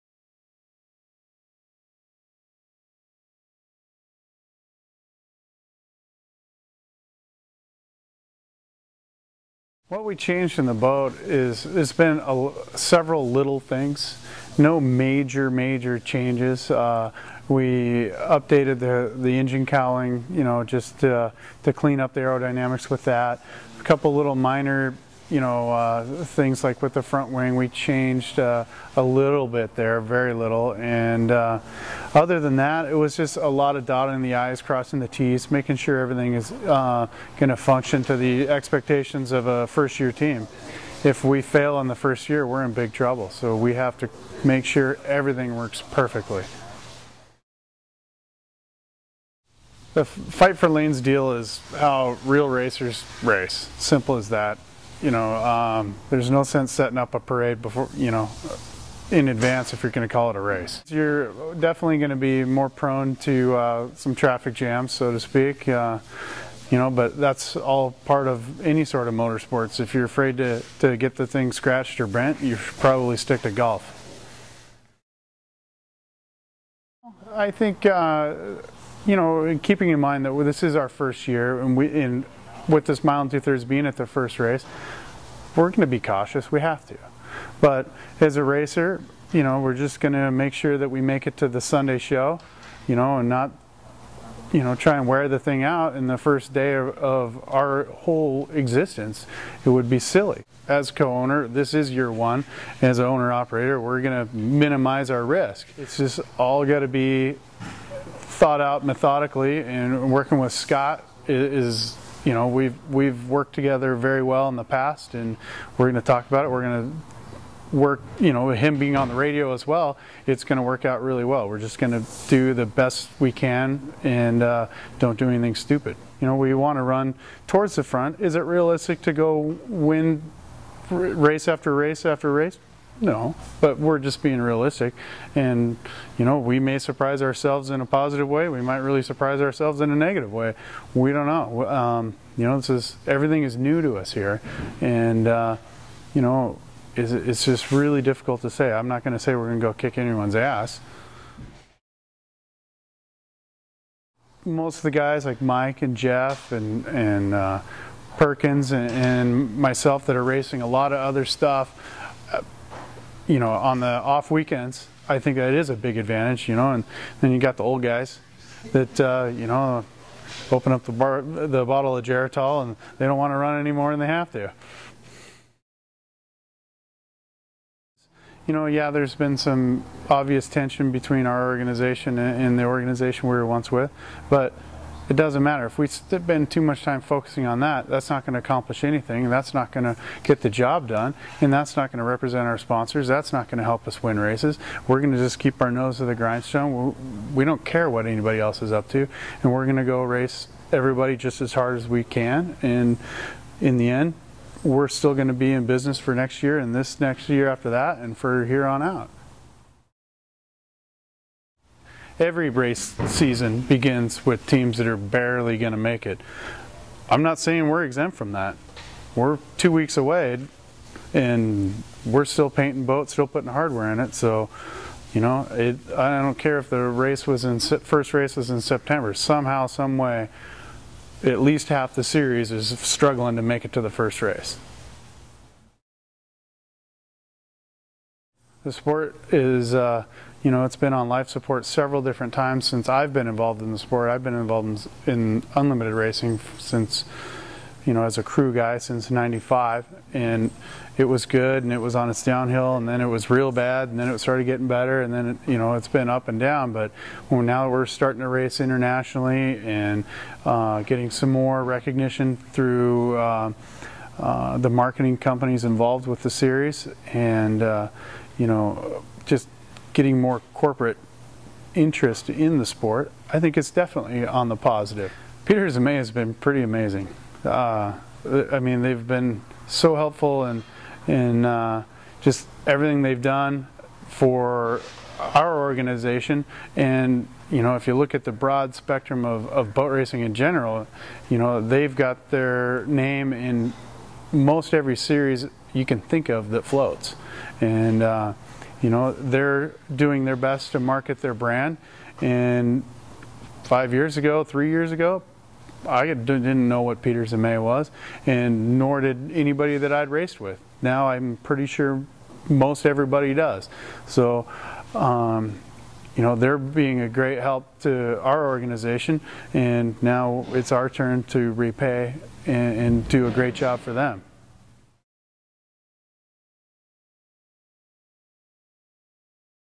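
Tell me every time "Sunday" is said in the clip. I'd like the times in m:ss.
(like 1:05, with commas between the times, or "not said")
1:31.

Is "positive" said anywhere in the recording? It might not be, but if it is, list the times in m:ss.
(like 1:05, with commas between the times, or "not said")
2:17, 4:34.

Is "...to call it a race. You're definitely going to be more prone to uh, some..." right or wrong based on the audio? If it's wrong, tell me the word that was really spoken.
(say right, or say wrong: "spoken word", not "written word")
right.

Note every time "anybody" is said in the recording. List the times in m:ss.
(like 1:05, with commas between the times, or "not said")
3:18, 5:09.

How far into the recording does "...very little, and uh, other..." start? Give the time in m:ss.
0:30.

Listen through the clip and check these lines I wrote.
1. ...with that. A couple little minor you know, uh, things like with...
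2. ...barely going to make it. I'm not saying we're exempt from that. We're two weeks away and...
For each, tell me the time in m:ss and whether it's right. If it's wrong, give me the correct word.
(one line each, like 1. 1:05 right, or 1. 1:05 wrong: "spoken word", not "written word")
1. 0:22 right
2. 3:34 right.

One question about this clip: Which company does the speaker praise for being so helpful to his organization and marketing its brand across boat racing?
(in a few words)
Peters and May.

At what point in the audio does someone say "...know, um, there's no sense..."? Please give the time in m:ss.
0:55.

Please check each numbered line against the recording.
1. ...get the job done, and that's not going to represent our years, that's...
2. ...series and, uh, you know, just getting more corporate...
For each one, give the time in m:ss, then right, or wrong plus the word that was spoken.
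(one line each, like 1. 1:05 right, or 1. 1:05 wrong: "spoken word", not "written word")
1. 3:10 wrong: "sponsors", not "years"
2. 4:26 right.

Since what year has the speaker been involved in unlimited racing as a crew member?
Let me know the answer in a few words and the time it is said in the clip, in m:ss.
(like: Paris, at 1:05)
1995, at 4:09.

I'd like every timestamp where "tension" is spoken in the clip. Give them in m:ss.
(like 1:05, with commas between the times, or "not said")
3:00.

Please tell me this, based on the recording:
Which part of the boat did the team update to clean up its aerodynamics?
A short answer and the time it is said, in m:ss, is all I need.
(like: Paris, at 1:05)
Engine cowling, at 0:19.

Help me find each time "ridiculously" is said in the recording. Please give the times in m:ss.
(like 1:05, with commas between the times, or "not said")
not said.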